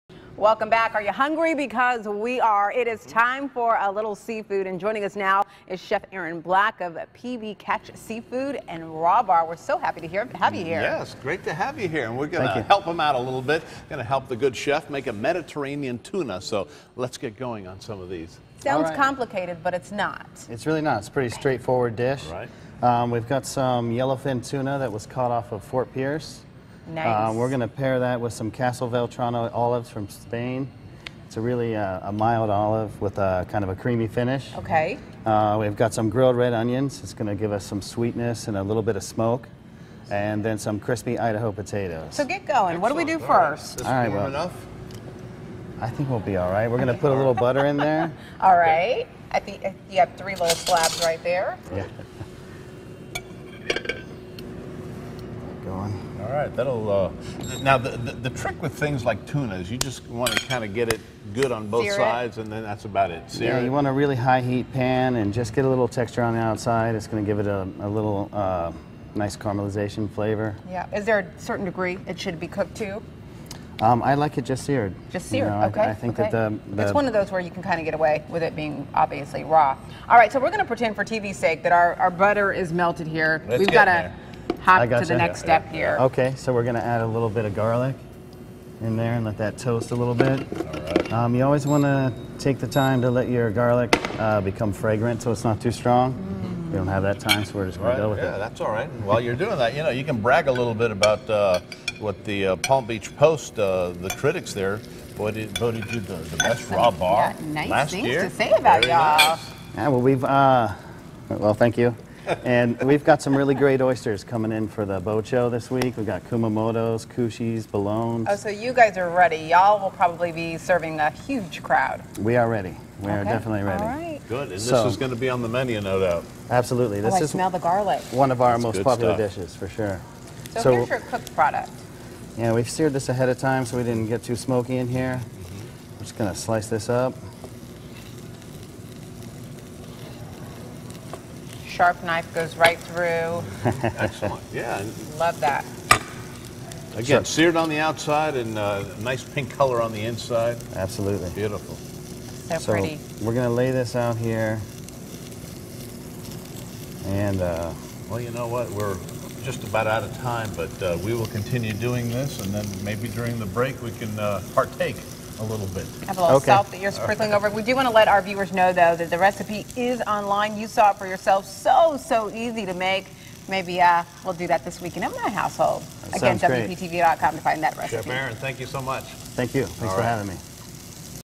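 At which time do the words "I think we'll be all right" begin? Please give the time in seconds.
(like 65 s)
45 s.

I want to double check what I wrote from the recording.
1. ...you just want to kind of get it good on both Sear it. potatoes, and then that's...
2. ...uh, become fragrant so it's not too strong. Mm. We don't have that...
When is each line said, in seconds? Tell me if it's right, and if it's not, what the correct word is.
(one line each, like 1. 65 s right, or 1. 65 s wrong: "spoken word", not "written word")
1. 59 s wrong: "sides", not "potatoes"
2. 94 s right.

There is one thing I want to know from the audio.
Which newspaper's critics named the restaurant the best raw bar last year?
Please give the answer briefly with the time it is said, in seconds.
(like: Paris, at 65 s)
Palm Beach Post, at 102 s.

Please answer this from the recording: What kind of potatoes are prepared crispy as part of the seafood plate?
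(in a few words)
Idaho.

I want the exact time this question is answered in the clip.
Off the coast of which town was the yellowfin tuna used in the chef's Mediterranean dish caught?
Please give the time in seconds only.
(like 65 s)
25 s.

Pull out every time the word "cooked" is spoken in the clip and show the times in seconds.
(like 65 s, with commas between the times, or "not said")
72 s, 130 s.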